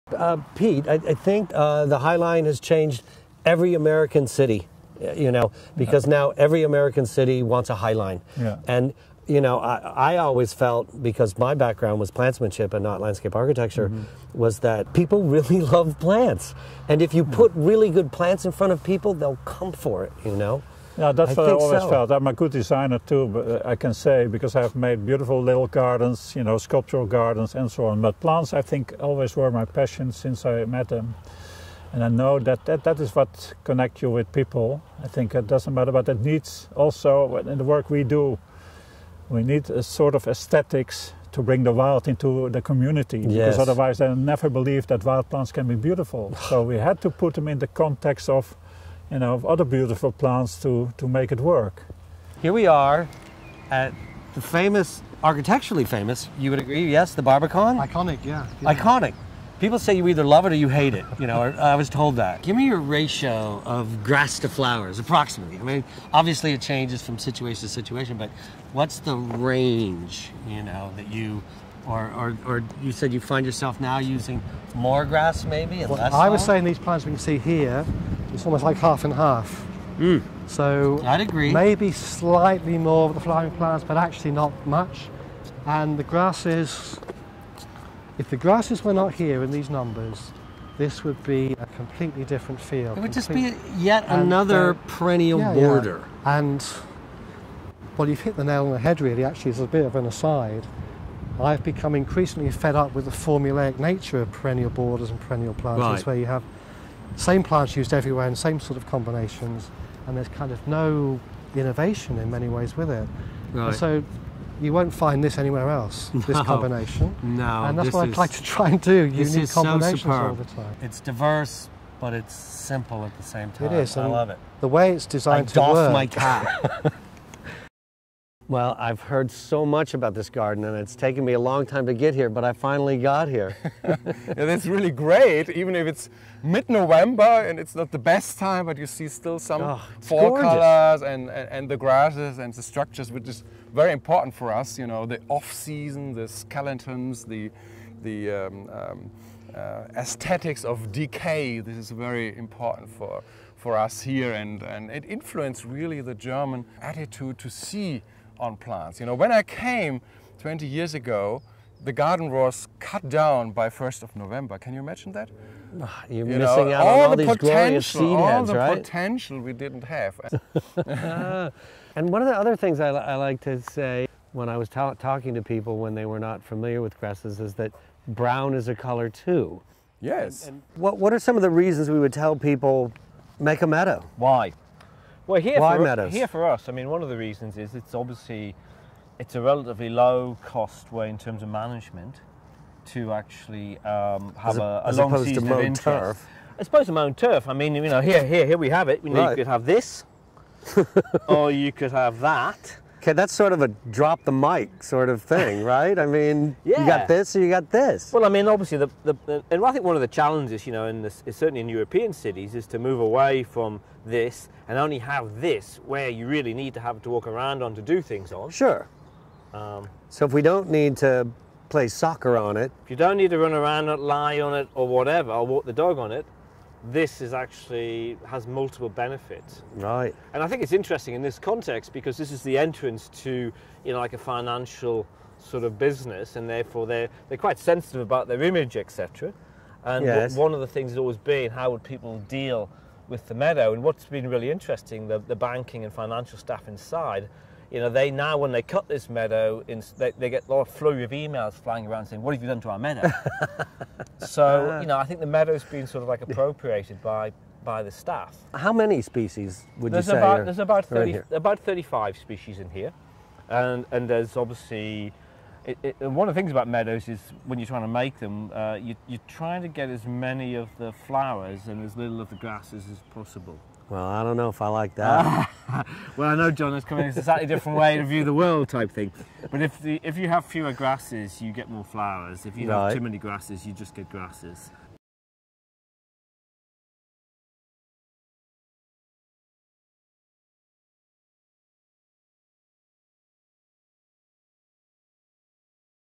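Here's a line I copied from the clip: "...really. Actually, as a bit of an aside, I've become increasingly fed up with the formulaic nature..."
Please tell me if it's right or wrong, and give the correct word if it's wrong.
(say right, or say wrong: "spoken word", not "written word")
right.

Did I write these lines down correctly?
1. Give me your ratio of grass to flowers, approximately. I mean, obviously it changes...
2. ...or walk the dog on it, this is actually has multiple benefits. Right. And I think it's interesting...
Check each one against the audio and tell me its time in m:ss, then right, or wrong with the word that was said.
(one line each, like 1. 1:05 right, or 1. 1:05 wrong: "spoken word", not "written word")
1. 1:02 right
2. 3:45 right.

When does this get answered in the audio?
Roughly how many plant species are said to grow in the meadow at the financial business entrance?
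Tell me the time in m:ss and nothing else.
4:21.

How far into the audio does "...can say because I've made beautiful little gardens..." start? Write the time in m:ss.
0:23.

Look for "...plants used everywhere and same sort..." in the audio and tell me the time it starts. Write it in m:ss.
1:47.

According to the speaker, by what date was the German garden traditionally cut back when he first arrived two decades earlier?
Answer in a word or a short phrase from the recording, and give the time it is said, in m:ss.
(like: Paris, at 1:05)
1st of November, at 2:43.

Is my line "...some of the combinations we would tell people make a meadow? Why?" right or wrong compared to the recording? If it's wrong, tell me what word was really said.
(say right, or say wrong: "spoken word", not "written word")
wrong: "reasons", not "combinations".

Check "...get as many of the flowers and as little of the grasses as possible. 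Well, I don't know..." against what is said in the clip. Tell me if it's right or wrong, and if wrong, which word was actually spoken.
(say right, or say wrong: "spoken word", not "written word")
right.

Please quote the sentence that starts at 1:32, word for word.
It would just be yet and, uh, another perennial yeah, border.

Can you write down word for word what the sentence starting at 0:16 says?
And if you put really good plants in front of people, they'll come for it, you know?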